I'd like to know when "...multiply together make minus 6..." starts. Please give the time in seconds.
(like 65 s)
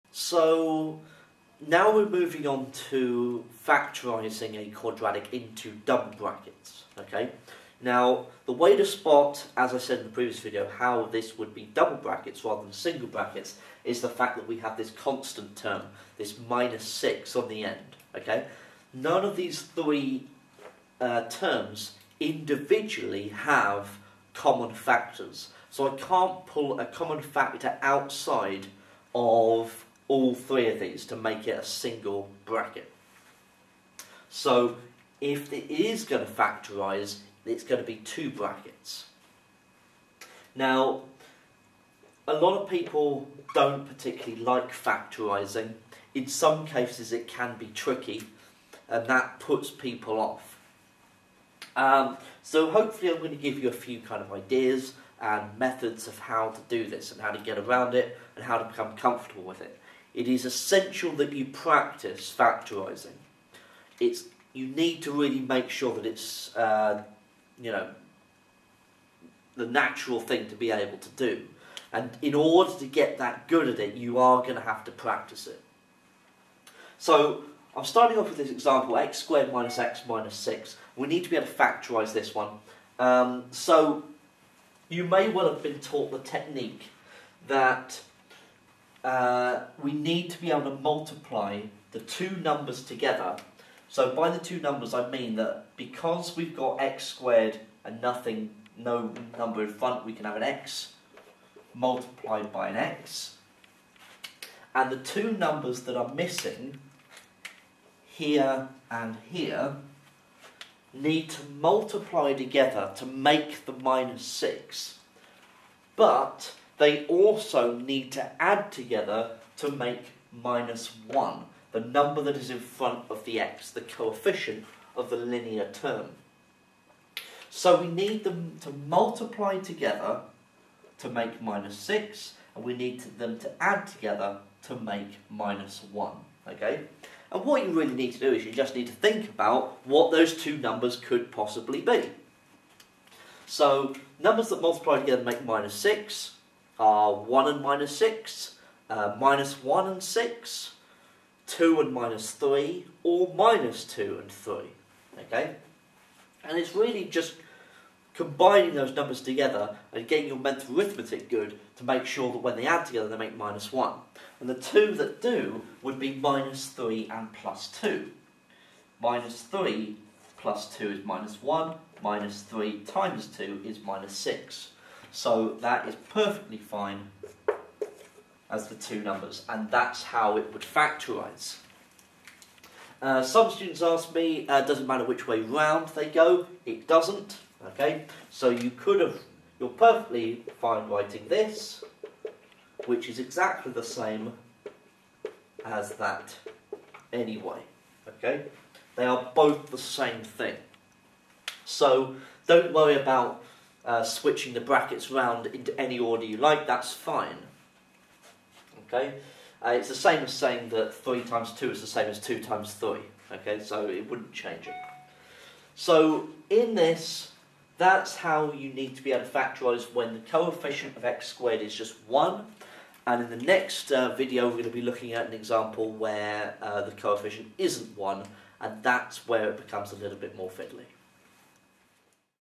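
144 s.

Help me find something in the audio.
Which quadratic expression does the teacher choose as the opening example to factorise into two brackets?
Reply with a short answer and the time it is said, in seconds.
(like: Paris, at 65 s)
x squared minus x minus 6, at 78 s.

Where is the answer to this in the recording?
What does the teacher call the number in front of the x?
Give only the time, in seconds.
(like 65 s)
123 s.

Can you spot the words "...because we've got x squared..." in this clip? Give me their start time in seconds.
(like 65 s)
95 s.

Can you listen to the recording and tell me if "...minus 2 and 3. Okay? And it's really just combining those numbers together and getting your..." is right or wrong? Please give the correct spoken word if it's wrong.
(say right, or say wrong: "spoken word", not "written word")
right.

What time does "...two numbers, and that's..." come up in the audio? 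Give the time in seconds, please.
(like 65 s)
178 s.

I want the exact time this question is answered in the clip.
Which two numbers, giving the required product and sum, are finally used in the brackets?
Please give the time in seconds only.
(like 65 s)
166 s.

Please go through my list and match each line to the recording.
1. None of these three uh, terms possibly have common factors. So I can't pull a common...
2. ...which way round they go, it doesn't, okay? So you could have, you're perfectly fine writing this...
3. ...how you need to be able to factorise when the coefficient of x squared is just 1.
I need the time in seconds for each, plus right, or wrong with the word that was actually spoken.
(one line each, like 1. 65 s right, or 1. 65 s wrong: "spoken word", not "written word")
1. 18 s wrong: "individually", not "possibly"
2. 185 s right
3. 218 s right.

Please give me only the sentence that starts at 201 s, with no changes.
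So don't worry about uh, switching the brackets round into any order you like, that's fine.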